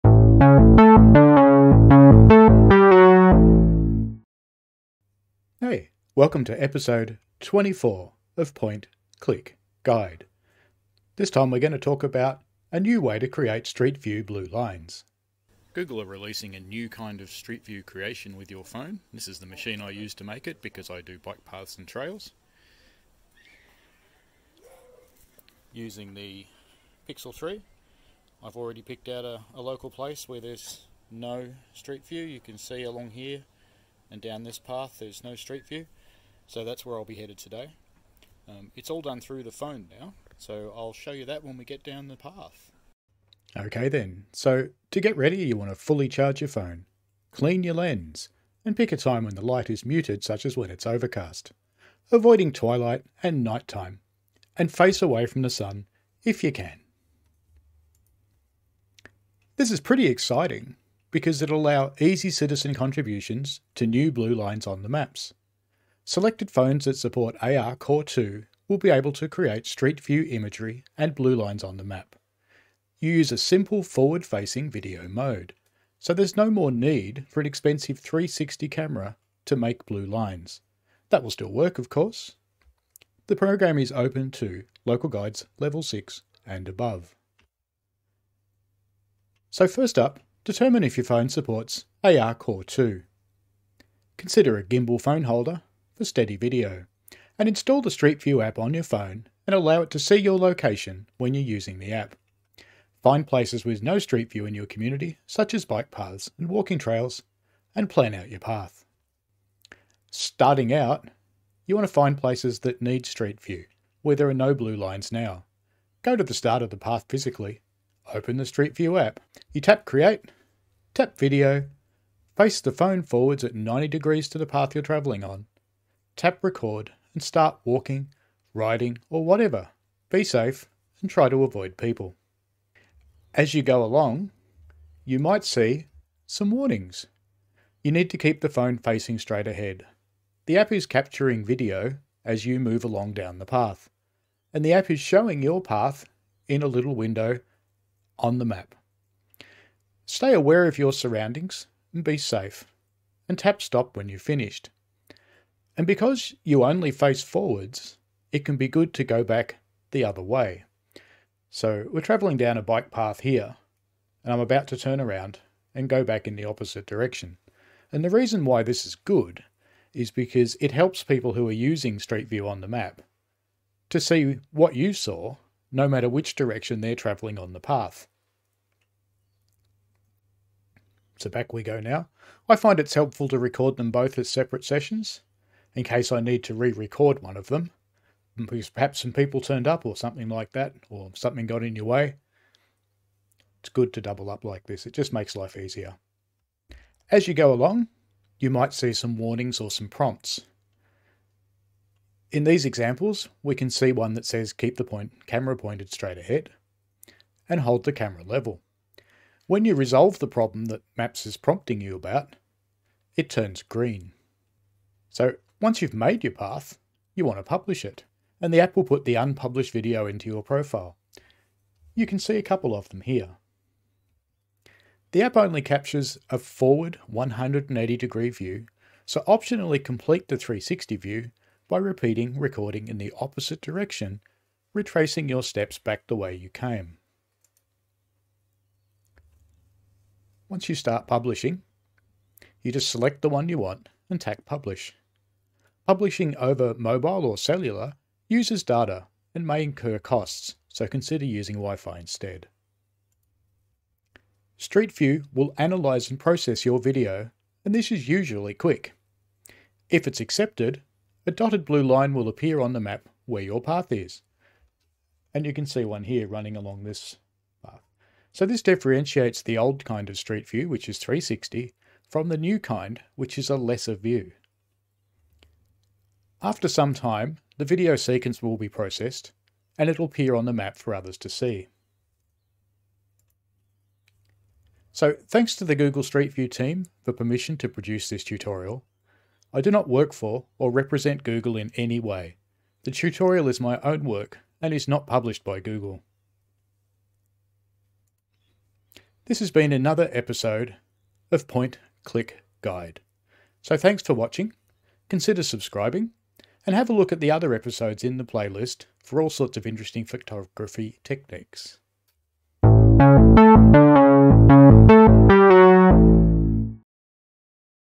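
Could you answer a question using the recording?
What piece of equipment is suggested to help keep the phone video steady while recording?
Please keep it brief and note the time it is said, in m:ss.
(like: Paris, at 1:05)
Gimbal phone holder, at 1:34.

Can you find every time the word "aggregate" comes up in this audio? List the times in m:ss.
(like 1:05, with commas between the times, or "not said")
not said.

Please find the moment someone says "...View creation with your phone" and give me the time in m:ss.
0:17.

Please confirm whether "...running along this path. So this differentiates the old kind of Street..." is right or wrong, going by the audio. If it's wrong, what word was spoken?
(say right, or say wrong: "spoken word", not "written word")
right.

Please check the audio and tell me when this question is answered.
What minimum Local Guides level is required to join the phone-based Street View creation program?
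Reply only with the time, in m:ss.
1:25.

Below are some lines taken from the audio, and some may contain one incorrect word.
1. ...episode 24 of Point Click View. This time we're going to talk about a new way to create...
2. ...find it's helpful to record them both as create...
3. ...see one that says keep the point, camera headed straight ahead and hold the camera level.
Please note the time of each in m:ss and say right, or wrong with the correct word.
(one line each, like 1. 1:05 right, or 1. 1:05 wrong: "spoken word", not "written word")
1. 0:06 wrong: "Guide", not "View"
2. 3:02 wrong: "separate", not "create"
3. 3:23 wrong: "pointed", not "headed".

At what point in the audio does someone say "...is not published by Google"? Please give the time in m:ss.
4:54.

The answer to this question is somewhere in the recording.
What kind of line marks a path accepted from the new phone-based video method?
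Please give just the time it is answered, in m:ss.
4:21.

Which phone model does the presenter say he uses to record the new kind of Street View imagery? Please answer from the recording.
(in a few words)
Pixel 3.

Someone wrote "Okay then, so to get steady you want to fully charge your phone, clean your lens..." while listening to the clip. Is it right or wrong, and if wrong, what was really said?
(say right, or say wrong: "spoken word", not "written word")
wrong: "ready", not "steady".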